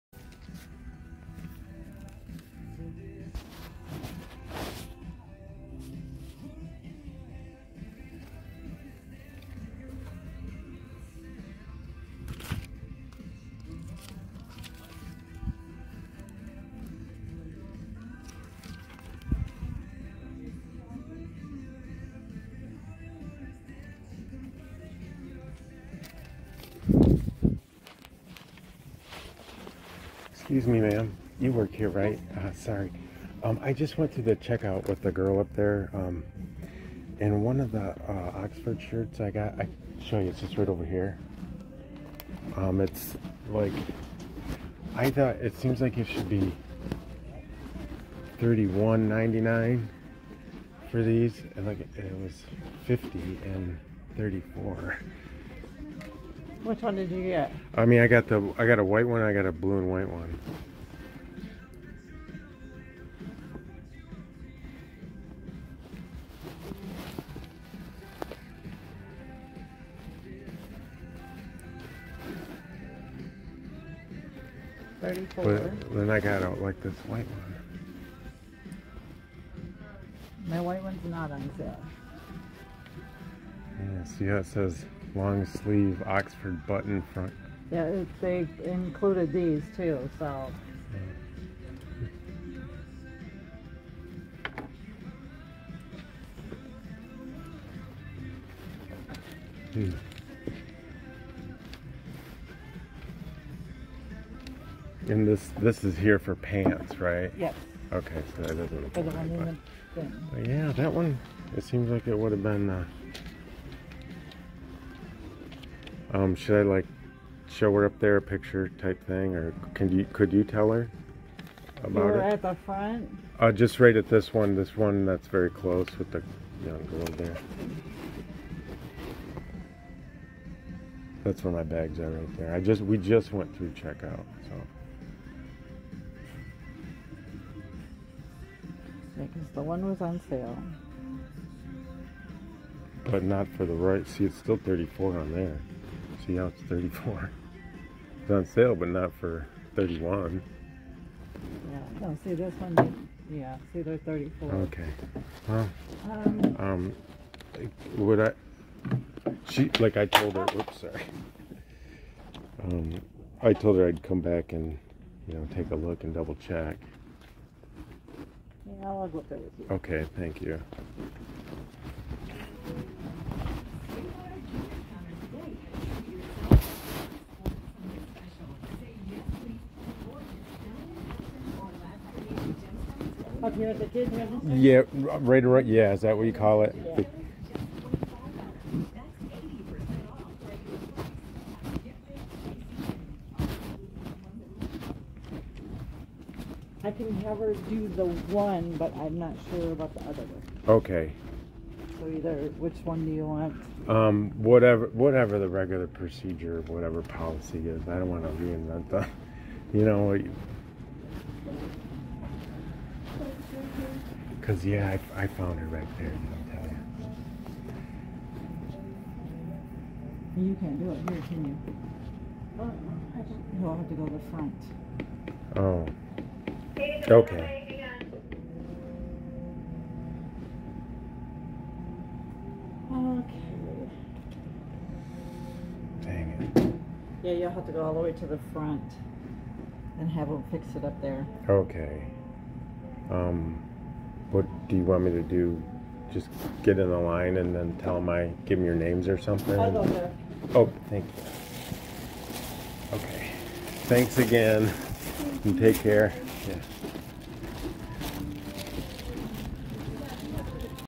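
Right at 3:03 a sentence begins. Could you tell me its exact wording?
Up here at the kids' Yeah, right around.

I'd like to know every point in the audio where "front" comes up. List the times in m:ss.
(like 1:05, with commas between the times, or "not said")
1:27, 2:02, 3:44, 3:58.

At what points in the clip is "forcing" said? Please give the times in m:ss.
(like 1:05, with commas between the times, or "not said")
not said.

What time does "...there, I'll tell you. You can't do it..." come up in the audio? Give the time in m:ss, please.
3:35.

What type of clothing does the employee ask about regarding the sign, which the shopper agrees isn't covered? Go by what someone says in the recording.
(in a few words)
Pants.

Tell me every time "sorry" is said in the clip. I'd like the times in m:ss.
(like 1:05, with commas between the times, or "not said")
0:32, 2:40.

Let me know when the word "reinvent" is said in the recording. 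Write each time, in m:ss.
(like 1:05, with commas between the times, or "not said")
3:28.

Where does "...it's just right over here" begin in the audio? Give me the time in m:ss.
0:40.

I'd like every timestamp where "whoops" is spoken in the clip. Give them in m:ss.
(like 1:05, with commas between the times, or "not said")
2:40.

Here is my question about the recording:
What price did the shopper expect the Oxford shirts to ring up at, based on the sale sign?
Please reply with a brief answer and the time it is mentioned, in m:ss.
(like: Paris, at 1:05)
$31.99, at 0:48.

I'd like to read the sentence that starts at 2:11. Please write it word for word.
That's where my bags are right there.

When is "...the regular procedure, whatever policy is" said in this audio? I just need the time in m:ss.
3:25.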